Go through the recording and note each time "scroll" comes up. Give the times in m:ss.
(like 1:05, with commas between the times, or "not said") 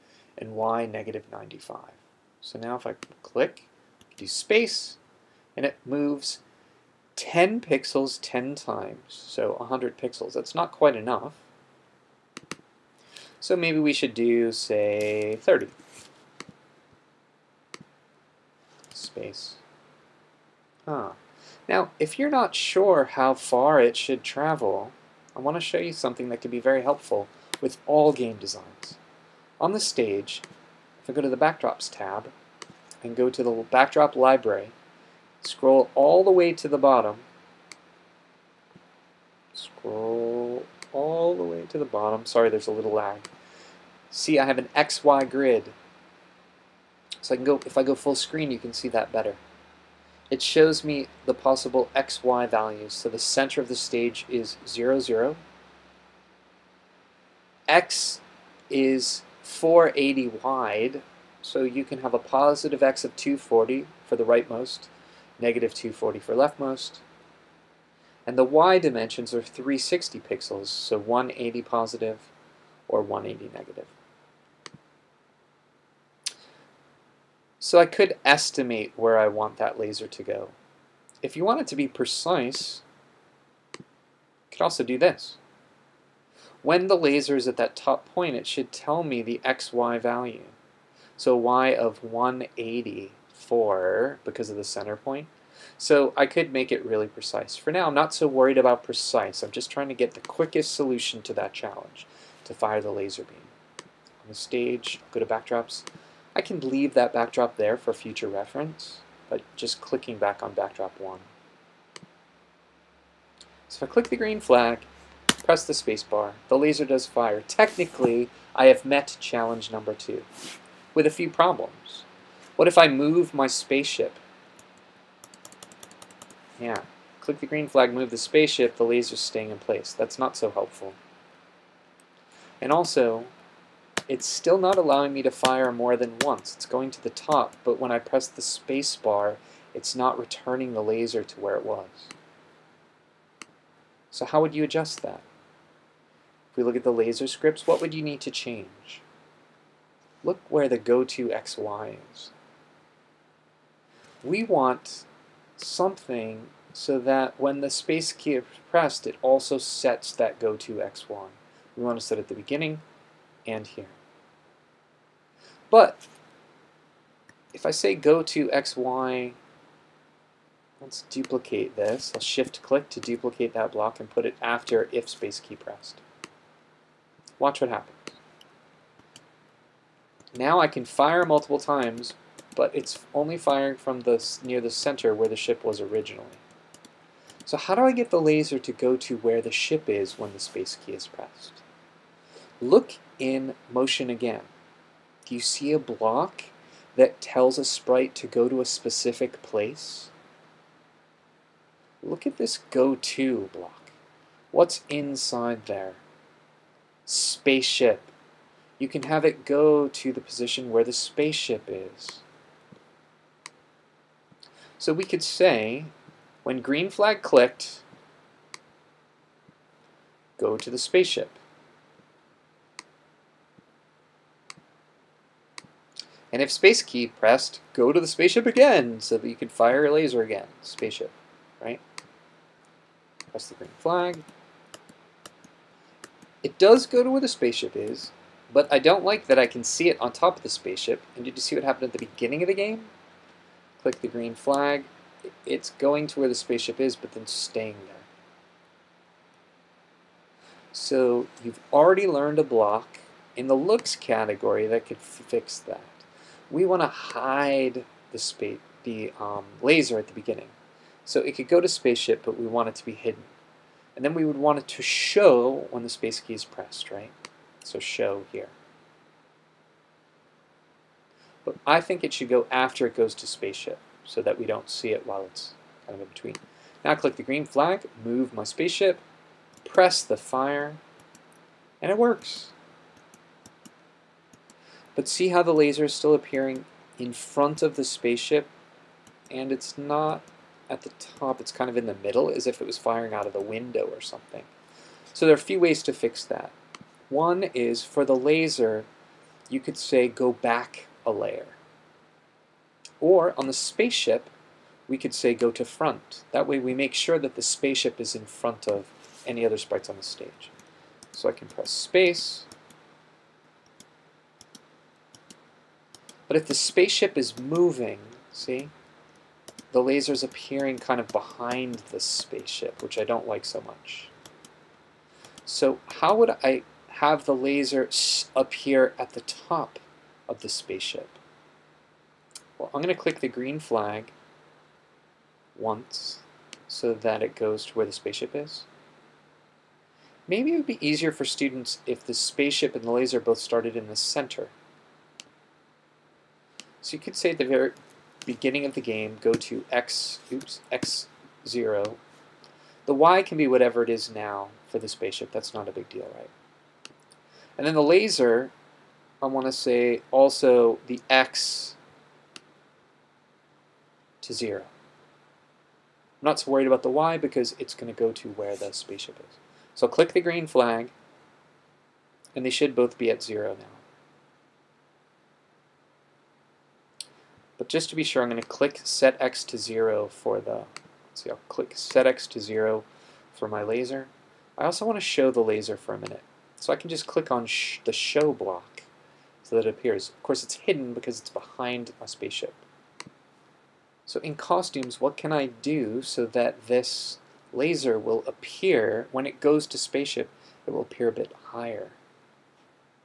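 0:35, 0:39.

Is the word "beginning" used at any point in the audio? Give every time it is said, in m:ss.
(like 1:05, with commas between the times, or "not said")
2:42, 4:02, 4:20, 5:48.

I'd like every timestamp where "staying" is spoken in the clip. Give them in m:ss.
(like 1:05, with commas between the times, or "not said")
2:09, 4:07.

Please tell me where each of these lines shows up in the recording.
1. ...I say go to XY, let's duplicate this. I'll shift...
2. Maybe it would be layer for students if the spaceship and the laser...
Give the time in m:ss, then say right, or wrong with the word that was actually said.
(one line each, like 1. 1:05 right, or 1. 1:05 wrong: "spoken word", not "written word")
1. 2:47 right
2. 5:40 wrong: "easier", not "layer".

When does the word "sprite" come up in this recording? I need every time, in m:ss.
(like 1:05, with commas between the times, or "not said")
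3:17, 5:09.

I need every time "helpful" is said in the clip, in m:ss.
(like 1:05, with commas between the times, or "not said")
0:26, 2:10.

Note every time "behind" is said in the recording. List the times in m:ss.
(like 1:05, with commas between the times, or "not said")
5:21, 6:31.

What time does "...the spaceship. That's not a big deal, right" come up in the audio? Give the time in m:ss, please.
5:54.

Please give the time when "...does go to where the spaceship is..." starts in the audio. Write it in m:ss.
3:56.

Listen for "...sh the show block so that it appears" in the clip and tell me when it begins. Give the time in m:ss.
6:27.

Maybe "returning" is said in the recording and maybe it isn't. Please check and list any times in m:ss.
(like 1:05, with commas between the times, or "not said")
2:20.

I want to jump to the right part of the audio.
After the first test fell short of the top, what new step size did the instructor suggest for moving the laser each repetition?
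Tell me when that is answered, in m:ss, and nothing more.
0:15.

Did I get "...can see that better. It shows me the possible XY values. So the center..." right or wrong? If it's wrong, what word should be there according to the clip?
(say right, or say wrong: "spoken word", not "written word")
right.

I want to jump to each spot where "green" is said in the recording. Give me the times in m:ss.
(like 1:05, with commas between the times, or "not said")
1:54, 2:07, 3:36, 3:53, 4:04, 4:37, 5:33, 6:10.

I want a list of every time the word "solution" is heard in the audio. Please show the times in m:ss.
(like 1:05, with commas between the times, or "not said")
1:40.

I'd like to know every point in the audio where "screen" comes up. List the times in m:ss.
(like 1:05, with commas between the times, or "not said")
0:48.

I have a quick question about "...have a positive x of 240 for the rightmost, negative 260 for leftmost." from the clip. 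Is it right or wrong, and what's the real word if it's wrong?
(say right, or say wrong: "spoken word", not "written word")
wrong: "240", not "260".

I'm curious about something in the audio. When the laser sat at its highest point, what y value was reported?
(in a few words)
184.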